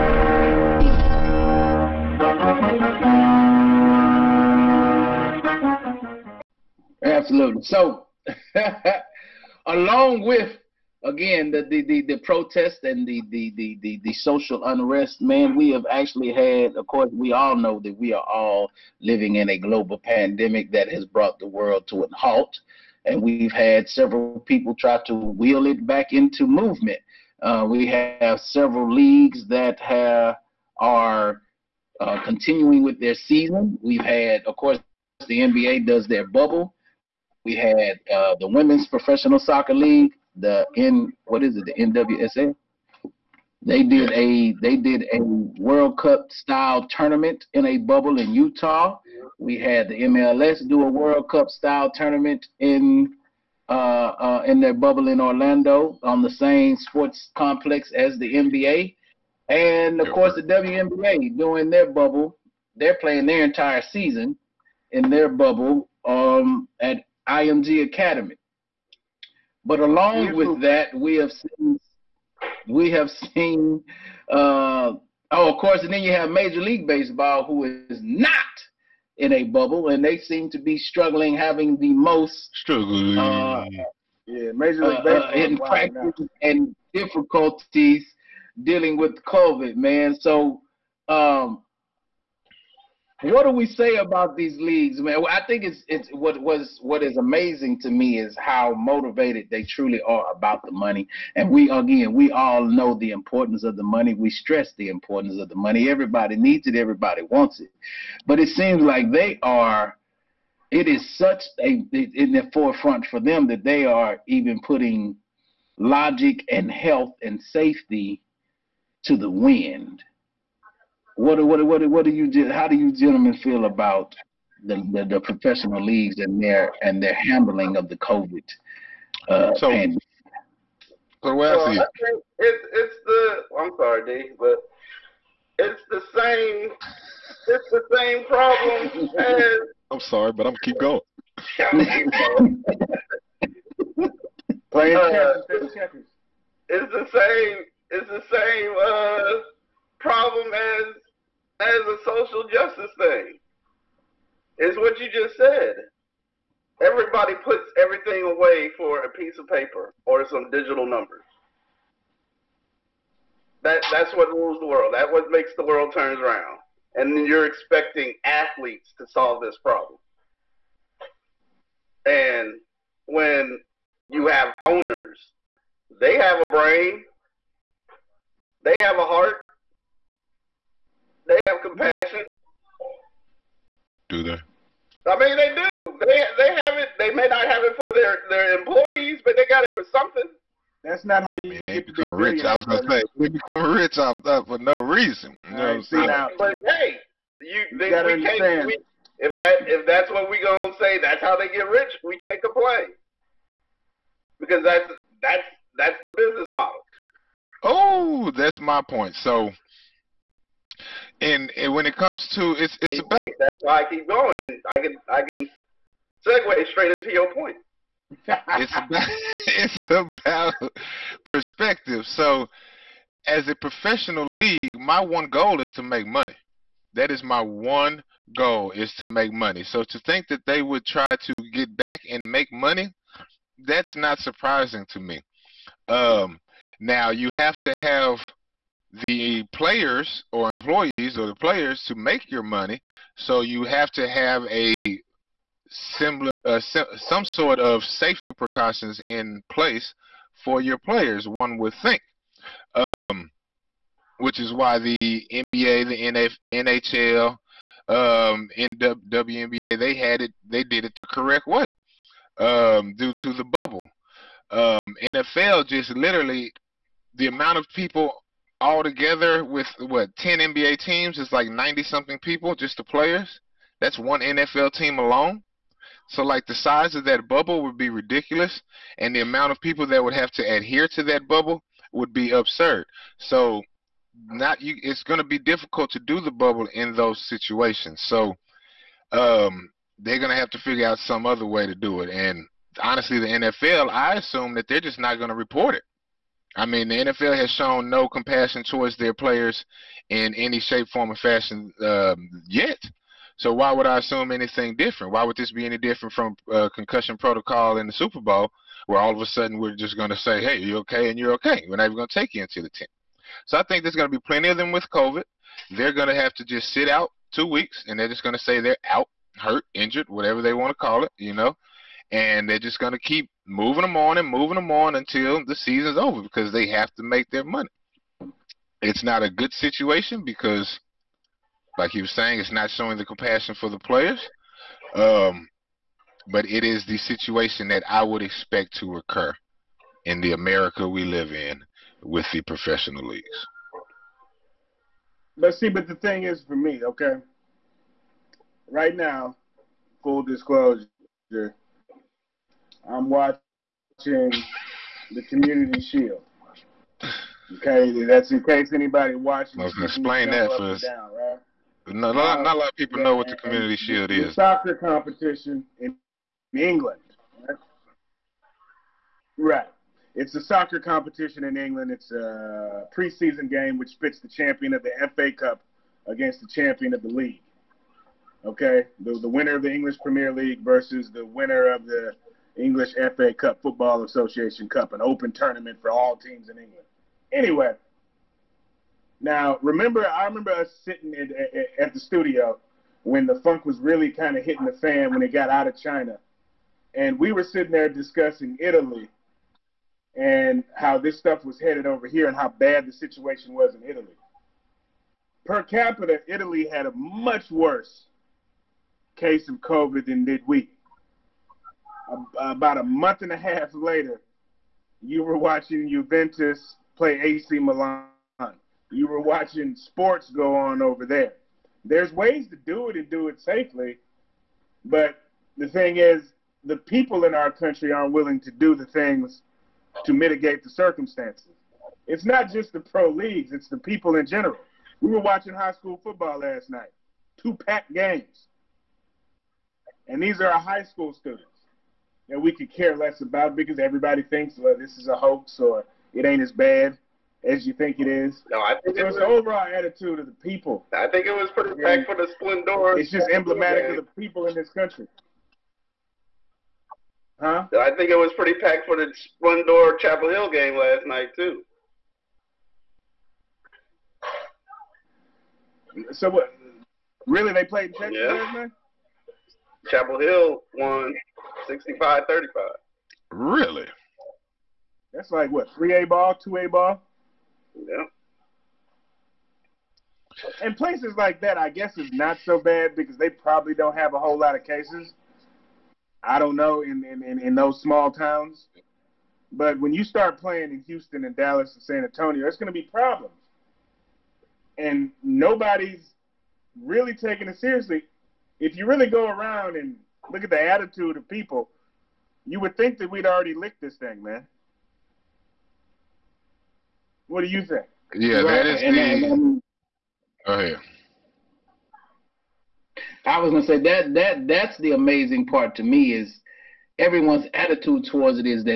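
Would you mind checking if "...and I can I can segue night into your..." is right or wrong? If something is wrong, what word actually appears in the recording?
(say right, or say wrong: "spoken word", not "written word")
wrong: "straight", not "night".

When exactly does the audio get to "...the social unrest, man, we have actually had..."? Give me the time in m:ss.
0:14.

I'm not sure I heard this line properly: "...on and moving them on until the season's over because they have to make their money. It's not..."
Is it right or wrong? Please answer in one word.
right.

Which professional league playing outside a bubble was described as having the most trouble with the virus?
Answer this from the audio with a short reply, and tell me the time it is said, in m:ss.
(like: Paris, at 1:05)
Major League Baseball, at 1:16.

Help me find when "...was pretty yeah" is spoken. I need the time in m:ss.
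7:31.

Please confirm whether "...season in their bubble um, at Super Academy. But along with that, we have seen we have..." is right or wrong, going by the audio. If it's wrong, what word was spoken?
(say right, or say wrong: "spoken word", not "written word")
wrong: "IMG", not "Super".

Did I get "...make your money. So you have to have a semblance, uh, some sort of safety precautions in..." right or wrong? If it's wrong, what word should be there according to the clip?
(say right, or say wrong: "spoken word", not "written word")
right.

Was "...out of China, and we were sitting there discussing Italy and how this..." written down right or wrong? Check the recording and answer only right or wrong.
right.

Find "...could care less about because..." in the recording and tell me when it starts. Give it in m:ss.
7:22.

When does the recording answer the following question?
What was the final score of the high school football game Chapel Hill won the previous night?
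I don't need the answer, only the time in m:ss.
7:51.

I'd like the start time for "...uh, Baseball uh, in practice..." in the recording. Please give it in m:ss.
1:25.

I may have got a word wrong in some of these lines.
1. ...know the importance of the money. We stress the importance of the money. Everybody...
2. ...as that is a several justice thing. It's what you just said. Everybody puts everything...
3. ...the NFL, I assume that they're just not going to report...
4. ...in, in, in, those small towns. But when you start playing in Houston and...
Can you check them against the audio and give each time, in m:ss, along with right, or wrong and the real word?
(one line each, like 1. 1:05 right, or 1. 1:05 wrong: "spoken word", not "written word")
1. 1:42 right
2. 2:30 wrong: "social", not "several"
3. 4:53 right
4. 8:06 right.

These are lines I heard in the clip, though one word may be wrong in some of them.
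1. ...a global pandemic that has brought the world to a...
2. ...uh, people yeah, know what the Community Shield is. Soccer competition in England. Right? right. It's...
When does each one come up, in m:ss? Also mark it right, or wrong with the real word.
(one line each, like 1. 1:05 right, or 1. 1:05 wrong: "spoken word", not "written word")
1. 0:19 right
2. 6:02 right.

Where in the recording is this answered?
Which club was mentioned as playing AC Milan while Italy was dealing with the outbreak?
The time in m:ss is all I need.
6:55.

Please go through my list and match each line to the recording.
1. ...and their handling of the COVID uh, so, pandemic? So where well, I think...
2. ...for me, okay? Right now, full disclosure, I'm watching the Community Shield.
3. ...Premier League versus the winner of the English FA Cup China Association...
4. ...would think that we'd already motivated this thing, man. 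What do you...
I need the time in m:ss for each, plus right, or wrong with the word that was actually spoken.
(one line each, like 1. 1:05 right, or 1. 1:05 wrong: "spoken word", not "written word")
1. 2:06 right
2. 5:46 right
3. 6:20 wrong: "Football", not "China"
4. 8:22 wrong: "licked", not "motivated".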